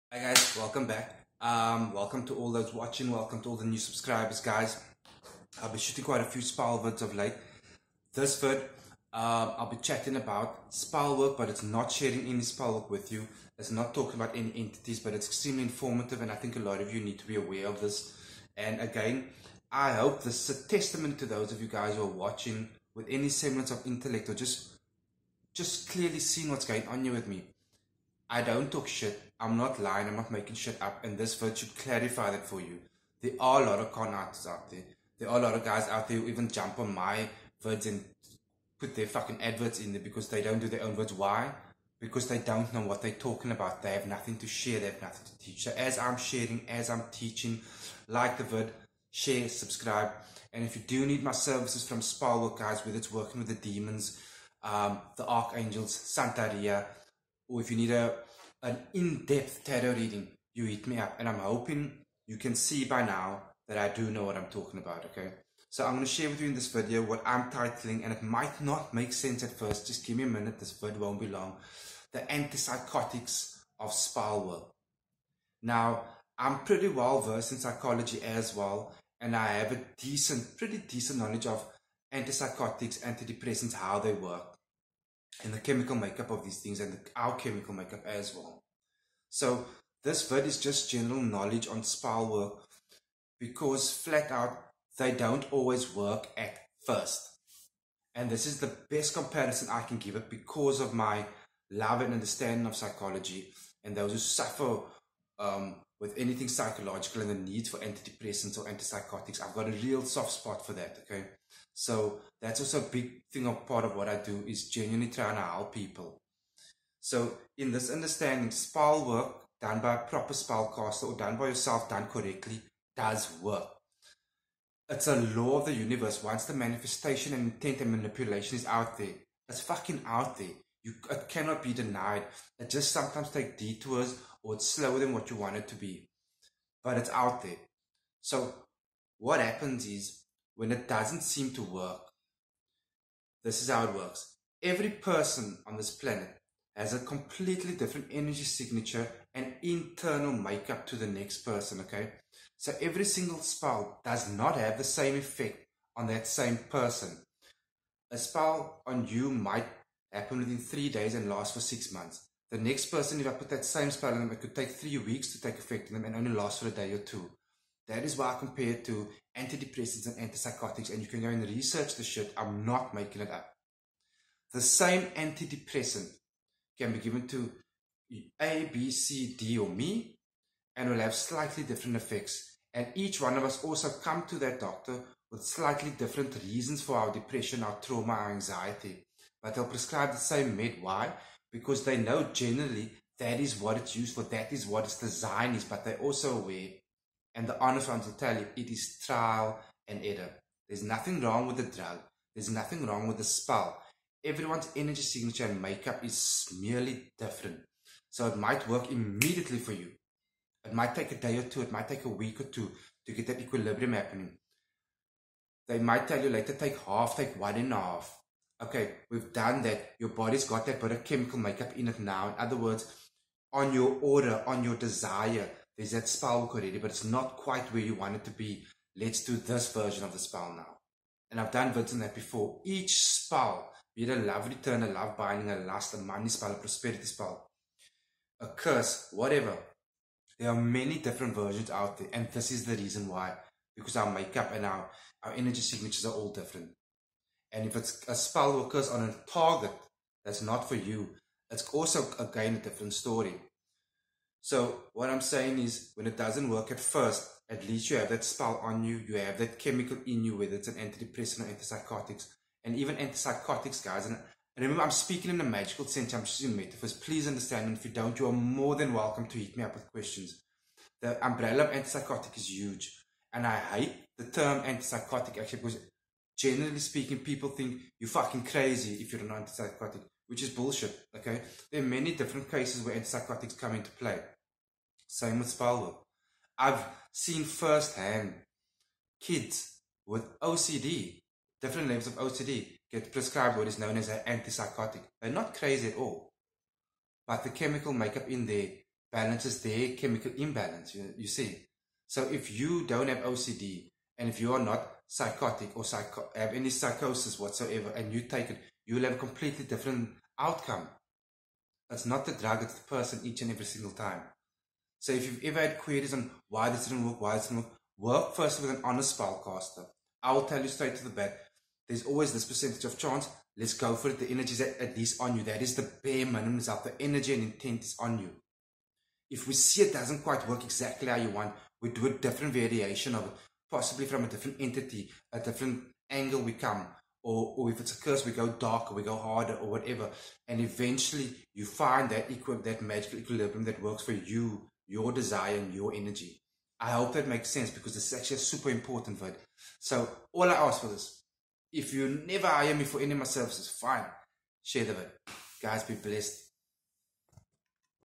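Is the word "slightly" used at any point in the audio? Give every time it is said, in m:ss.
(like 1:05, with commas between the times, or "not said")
3:01, 3:05.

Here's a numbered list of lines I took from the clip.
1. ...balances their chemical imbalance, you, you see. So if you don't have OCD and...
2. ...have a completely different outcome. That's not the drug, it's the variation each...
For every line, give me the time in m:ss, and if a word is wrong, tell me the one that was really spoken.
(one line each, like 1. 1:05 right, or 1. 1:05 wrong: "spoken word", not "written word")
1. 4:59 right
2. 5:09 wrong: "person", not "variation".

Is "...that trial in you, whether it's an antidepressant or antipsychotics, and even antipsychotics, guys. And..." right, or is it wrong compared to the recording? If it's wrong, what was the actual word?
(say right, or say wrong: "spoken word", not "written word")
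wrong: "chemical", not "trial".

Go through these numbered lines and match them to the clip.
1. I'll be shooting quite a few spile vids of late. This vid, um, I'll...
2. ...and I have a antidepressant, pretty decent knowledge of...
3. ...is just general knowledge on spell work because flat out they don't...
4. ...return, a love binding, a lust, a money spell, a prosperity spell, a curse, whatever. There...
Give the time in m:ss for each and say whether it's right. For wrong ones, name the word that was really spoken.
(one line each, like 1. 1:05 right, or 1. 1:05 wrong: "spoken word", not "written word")
1. 0:05 right
2. 1:19 wrong: "decent", not "antidepressant"
3. 1:30 right
4. 3:54 right.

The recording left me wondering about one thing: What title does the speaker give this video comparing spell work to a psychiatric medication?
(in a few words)
The Antipsychotics of Spellwork.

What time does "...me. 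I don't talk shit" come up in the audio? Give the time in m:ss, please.
0:27.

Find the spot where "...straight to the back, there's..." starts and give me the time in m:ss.
5:20.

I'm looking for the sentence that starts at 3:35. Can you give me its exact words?
They might tell you later, take half, take one and a half.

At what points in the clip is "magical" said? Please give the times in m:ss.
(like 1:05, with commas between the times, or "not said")
4:25, 5:42.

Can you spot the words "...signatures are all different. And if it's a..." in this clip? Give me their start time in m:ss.
4:05.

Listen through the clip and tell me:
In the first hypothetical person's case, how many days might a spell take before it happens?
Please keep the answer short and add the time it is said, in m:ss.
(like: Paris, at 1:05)
3 days, at 2:40.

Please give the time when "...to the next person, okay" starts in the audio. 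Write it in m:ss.
2:30.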